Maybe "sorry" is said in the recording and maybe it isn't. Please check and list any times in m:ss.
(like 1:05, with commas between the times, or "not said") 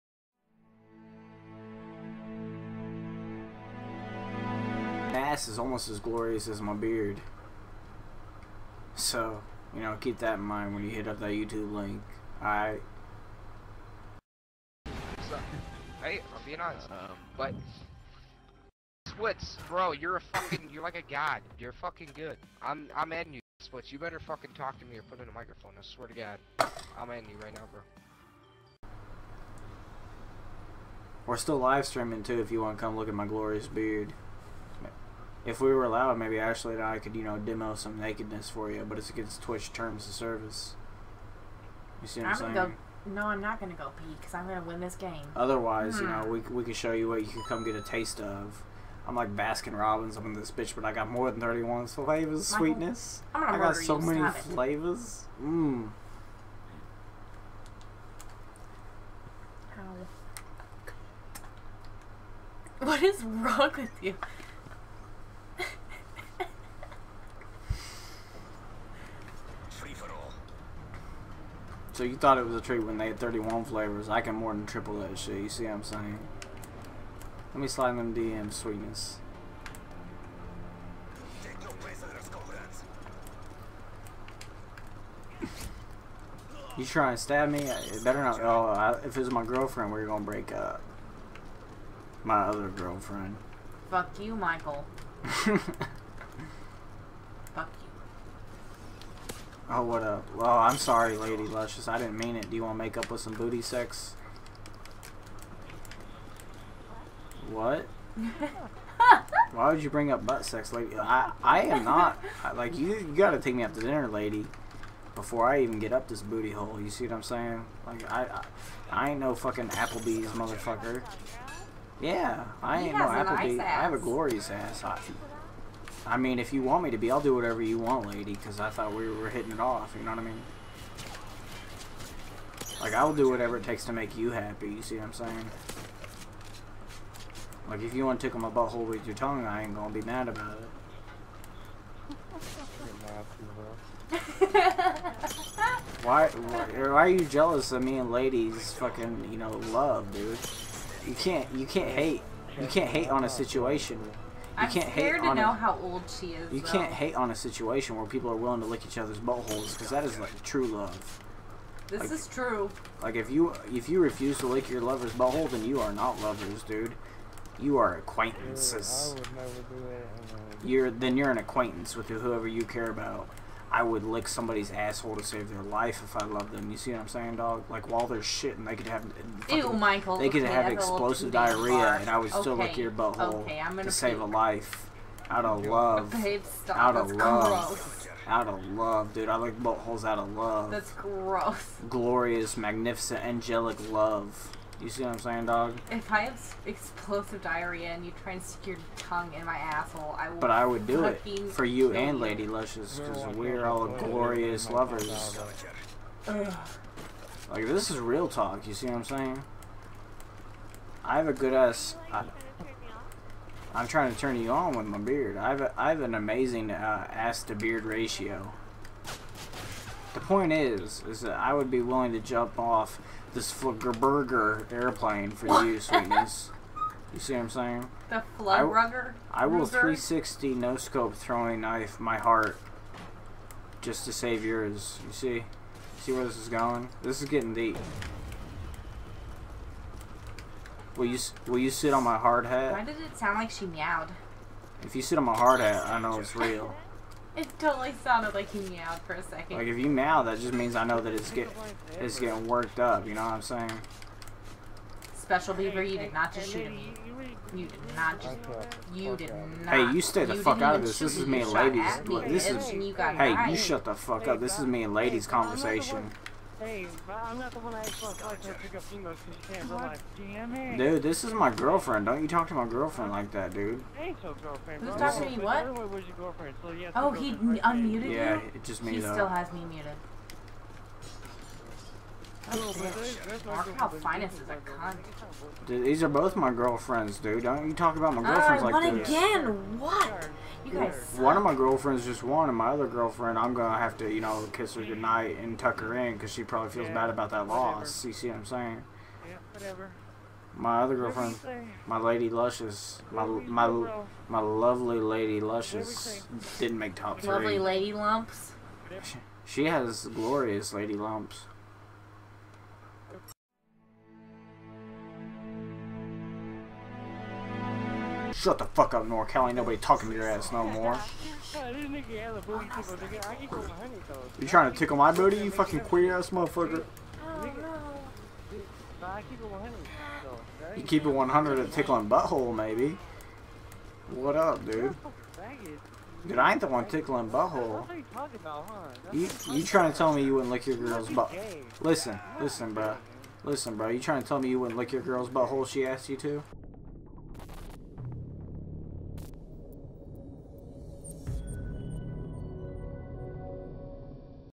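1:40.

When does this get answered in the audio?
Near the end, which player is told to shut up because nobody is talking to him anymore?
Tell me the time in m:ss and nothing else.
5:19.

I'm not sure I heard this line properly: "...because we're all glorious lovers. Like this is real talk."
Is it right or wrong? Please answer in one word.
right.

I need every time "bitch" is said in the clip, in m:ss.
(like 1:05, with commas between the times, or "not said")
0:50.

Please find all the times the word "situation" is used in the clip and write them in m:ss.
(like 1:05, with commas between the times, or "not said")
2:33, 2:37.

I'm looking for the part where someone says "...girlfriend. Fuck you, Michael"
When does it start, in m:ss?
1:32.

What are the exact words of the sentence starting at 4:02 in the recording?
Why did it sound like she meowed?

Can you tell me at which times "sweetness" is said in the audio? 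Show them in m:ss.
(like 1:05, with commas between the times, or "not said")
0:52, 1:18, 3:45.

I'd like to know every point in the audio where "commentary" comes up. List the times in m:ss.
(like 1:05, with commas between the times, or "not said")
not said.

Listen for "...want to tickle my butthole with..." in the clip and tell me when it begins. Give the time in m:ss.
2:18.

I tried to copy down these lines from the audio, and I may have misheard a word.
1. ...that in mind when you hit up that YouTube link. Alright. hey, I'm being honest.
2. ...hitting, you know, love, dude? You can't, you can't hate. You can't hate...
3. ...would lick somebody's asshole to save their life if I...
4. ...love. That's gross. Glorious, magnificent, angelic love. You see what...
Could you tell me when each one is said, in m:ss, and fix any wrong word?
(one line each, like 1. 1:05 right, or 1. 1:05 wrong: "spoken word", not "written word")
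1. 0:10 right
2. 2:28 wrong: "fucking", not "hitting"
3. 2:53 right
4. 3:10 right.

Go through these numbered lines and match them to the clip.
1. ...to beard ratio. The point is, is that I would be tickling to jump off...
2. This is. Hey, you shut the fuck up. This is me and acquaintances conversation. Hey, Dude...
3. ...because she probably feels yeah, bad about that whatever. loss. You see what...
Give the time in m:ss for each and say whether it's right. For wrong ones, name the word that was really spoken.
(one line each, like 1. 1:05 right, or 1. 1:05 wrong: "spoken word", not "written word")
1. 3:37 wrong: "willing", not "tickling"
2. 4:22 wrong: "ladies", not "acquaintances"
3. 4:56 right.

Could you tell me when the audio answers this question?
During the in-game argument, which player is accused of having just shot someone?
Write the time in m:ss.
4:15.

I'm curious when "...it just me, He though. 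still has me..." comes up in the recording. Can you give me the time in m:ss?
4:38.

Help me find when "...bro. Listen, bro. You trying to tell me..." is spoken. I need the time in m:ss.
5:42.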